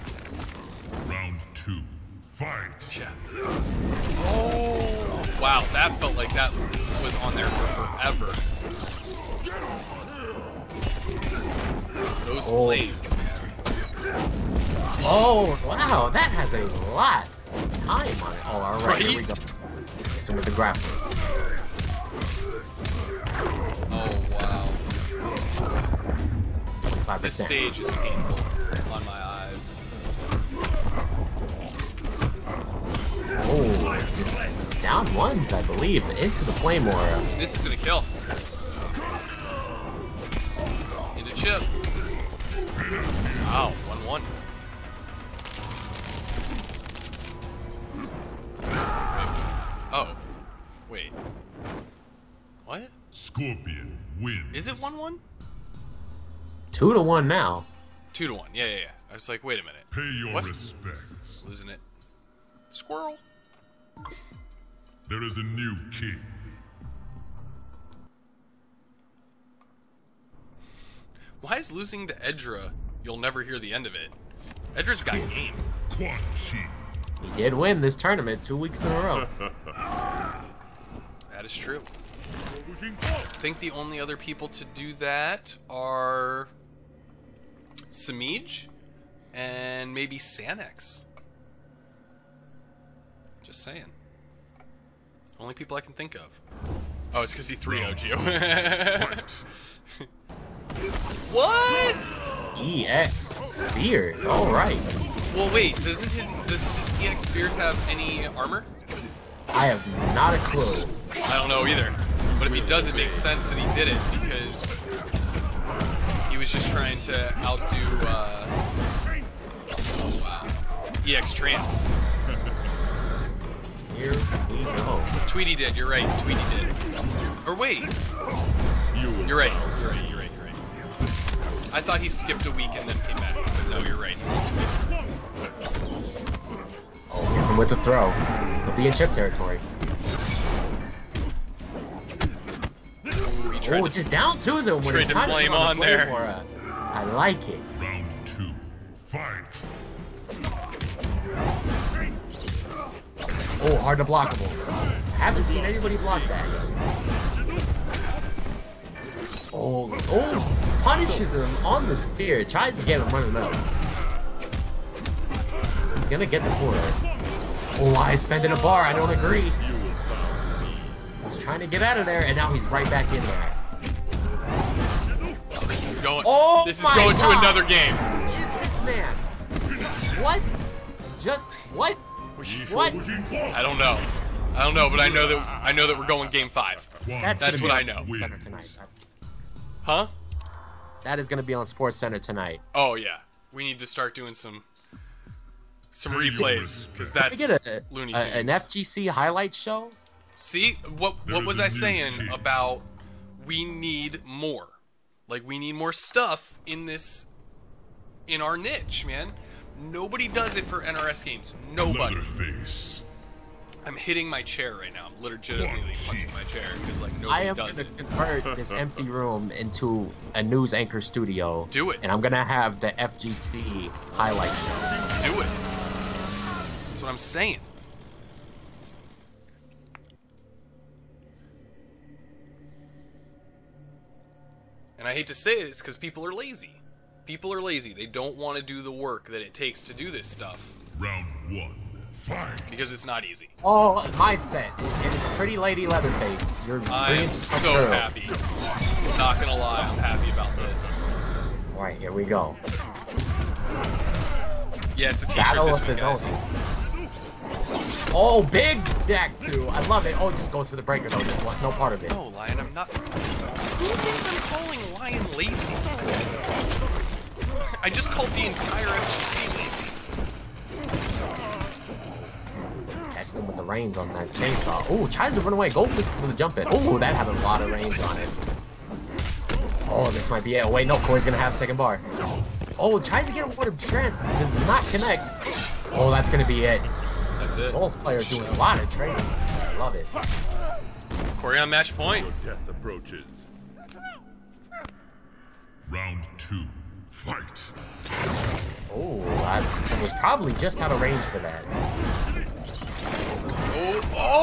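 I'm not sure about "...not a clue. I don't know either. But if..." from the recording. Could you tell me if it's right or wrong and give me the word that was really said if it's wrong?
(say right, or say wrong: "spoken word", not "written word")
right.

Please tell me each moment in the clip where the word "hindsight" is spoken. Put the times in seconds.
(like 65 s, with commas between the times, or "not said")
not said.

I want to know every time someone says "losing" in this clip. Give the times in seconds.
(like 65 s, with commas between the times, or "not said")
61 s, 71 s.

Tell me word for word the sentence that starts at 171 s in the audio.
He's trying to get out of there, and now he's right back in there.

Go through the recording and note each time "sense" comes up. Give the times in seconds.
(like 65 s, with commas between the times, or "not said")
113 s.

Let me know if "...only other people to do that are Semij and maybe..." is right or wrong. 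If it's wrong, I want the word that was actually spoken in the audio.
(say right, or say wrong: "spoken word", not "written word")
right.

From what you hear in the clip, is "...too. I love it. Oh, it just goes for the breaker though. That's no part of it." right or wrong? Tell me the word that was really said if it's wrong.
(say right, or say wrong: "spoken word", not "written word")
right.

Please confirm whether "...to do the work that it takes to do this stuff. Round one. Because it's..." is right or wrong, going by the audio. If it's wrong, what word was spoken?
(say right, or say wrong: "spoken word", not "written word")
right.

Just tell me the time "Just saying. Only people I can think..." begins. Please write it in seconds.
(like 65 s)
93 s.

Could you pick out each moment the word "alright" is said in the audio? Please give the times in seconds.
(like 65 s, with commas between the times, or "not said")
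18 s, 104 s, 251 s.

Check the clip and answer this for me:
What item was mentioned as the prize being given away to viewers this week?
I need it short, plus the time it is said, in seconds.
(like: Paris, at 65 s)
A t-shirt, at 255 s.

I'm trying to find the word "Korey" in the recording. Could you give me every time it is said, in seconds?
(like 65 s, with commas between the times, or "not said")
280 s, 291 s.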